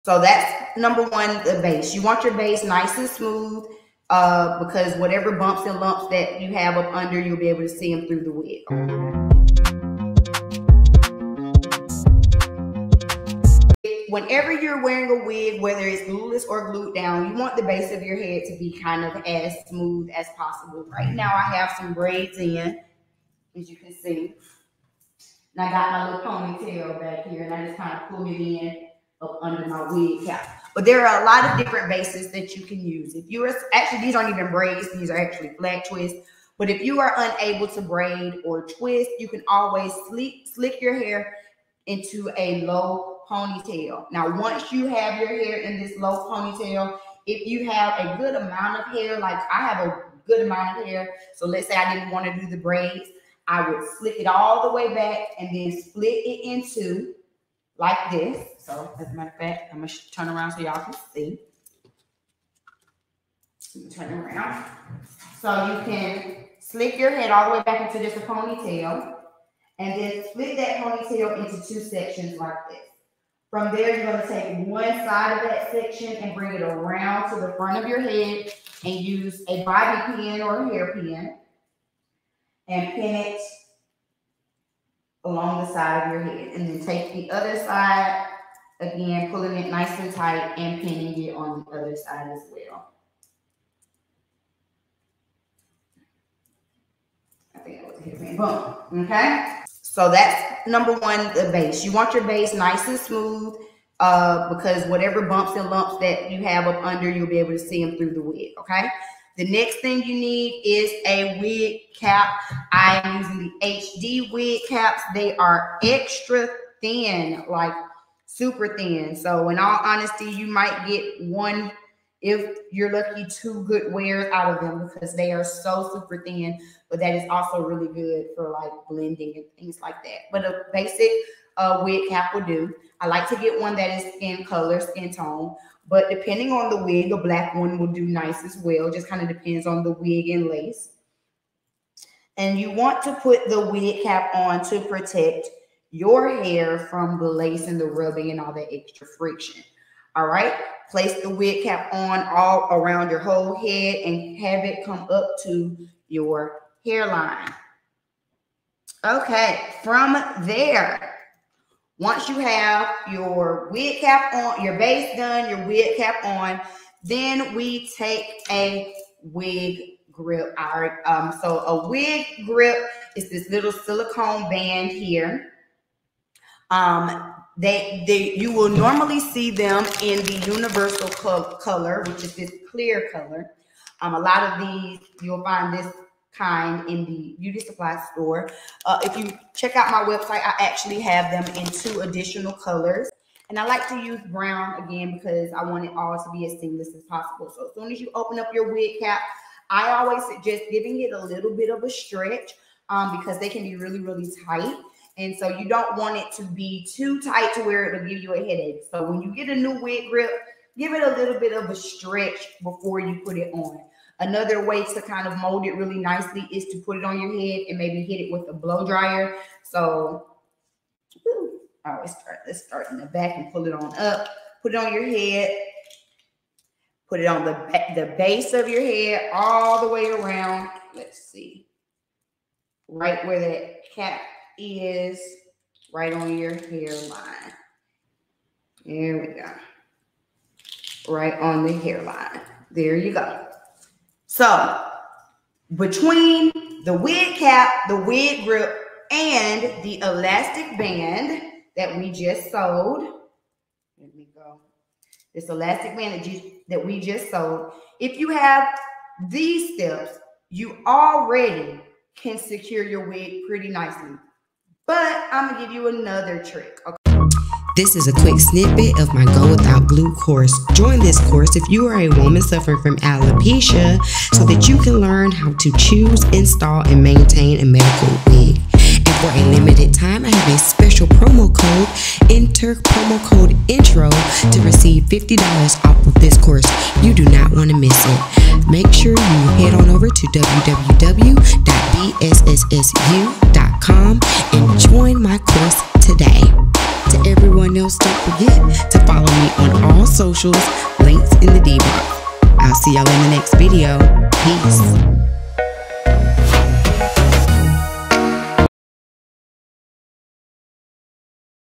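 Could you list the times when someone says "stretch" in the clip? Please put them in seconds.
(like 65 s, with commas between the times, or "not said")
201 s, 211 s.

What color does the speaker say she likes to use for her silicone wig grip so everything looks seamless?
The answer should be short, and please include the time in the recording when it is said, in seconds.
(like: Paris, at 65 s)
Brown, at 194 s.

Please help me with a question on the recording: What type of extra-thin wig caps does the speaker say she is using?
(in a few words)
HD wig caps.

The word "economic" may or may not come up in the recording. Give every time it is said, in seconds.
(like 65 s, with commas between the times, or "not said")
not said.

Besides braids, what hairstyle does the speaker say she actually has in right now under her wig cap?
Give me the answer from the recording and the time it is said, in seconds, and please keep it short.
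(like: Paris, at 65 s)
Flat twists, at 35 s.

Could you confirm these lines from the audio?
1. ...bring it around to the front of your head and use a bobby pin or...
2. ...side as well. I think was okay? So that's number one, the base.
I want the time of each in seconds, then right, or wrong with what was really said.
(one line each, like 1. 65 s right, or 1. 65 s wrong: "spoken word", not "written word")
1. 76 s right
2. 91 s right.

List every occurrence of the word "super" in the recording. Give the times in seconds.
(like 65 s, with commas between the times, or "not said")
118 s, 125 s.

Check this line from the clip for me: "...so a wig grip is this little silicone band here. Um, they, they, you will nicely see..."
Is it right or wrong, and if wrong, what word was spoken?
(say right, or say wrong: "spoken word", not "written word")
wrong: "normally", not "nicely".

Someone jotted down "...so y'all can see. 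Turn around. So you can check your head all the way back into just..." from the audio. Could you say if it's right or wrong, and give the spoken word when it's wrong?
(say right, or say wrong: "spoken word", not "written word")
wrong: "slick", not "check".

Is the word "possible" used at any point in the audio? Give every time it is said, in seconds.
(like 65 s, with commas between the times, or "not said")
20 s, 197 s.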